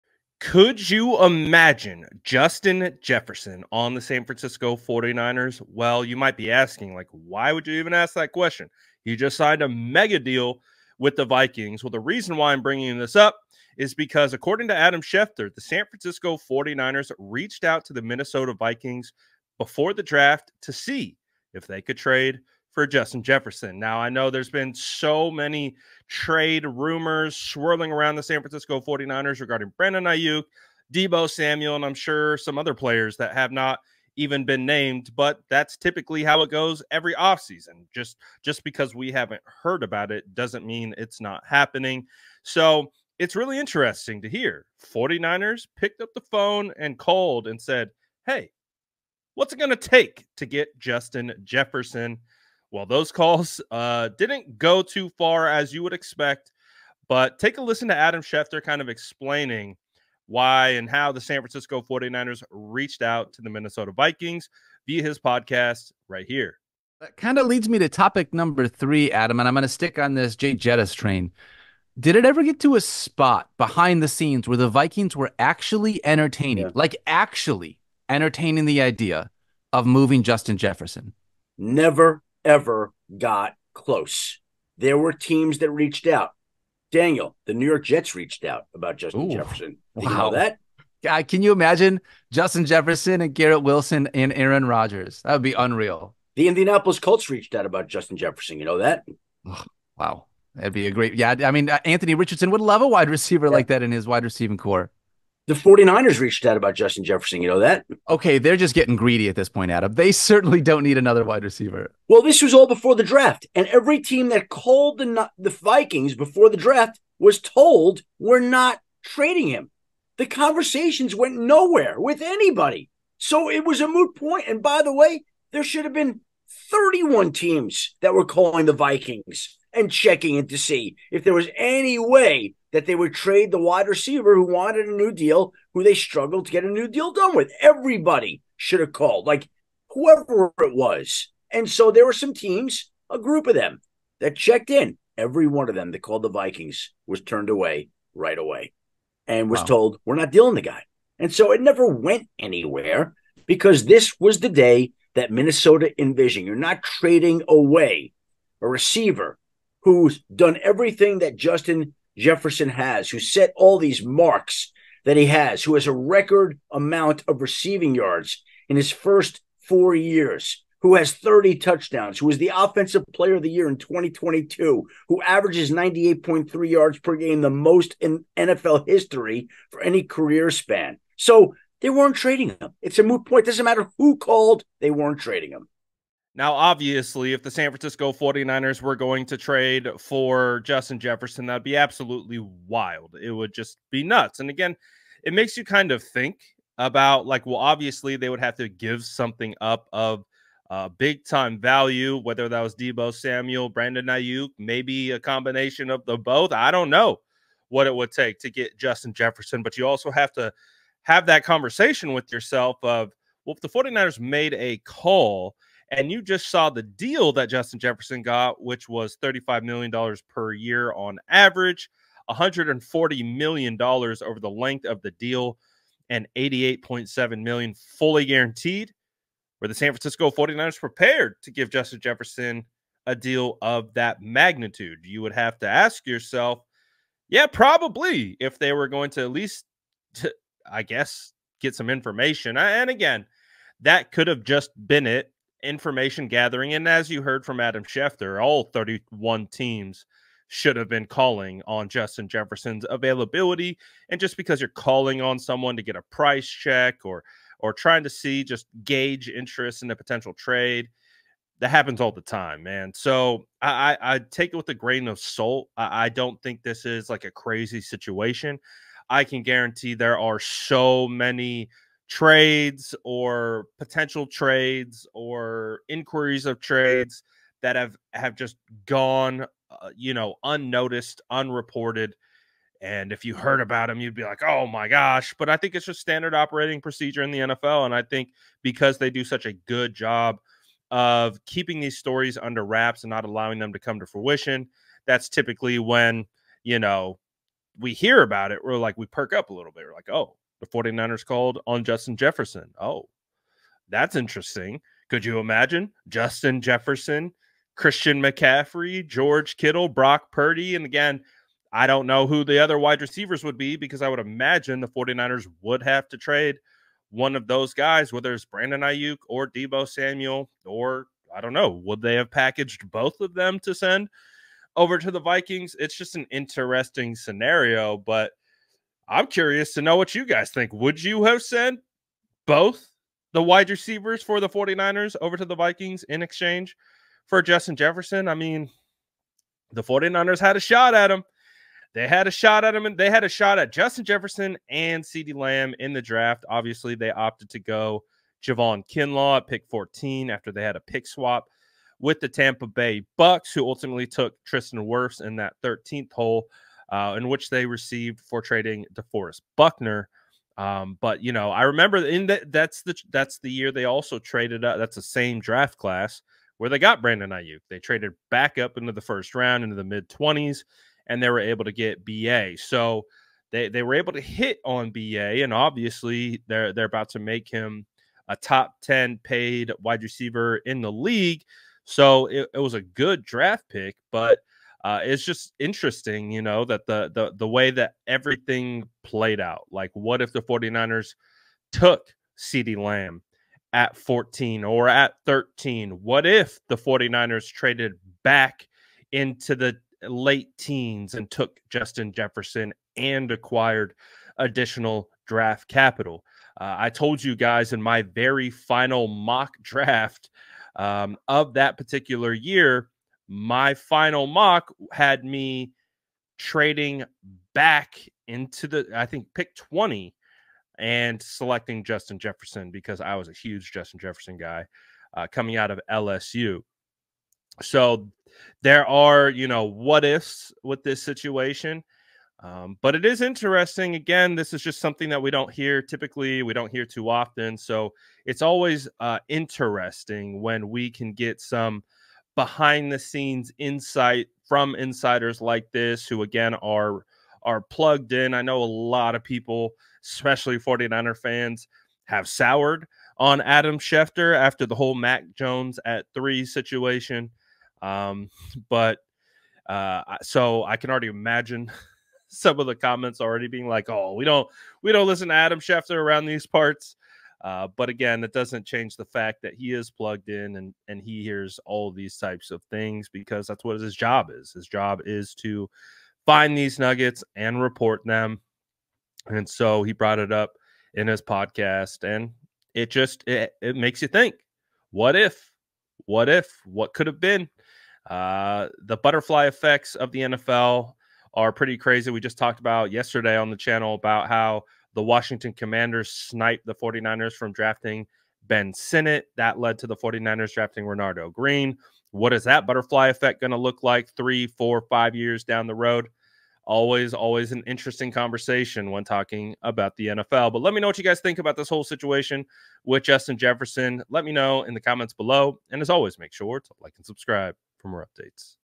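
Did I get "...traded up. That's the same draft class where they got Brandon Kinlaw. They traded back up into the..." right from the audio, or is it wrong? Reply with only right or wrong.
wrong.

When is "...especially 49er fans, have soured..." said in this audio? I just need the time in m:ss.
7:30.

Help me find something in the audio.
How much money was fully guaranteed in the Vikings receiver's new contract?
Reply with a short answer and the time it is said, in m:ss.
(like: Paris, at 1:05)
$88.7 million, at 3:46.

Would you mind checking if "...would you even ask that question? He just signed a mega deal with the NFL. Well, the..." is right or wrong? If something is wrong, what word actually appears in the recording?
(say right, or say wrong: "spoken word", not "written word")
wrong: "Vikings", not "NFL".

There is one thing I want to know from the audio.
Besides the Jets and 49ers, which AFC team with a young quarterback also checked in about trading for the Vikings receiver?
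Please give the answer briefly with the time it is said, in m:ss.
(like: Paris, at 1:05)
Indianapolis Colts, at 1:36.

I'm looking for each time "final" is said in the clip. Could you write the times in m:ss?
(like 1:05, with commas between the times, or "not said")
6:48, 6:53.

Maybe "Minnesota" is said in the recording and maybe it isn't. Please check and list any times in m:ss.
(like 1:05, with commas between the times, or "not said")
0:18, 1:03, 2:35.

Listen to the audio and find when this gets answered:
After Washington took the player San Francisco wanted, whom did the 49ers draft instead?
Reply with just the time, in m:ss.
8:20.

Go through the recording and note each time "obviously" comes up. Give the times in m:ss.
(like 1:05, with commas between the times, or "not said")
3:06, 3:17, 5:46, 6:15.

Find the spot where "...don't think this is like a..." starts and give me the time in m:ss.
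4:26.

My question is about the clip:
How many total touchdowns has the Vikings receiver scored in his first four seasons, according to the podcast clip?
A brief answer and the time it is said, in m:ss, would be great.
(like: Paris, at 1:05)
30, at 2:51.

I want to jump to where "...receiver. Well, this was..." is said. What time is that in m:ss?
1:51.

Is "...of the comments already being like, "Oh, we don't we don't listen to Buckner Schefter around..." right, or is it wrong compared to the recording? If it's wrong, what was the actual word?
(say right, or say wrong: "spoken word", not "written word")
wrong: "Adam", not "Buckner".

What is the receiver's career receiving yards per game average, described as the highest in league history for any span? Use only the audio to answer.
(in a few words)
98.3.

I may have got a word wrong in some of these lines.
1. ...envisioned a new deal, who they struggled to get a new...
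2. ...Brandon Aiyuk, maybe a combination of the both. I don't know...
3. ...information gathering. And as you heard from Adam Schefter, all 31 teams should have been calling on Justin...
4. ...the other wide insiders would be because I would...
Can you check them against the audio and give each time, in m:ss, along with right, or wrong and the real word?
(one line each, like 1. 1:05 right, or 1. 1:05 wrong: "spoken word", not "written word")
1. 2:14 wrong: "wanted", not "envisioned"
2. 3:23 right
3. 4:05 right
4. 5:12 wrong: "receivers", not "insiders".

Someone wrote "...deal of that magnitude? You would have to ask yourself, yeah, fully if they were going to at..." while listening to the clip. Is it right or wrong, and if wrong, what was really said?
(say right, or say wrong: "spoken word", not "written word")
wrong: "probably", not "fully".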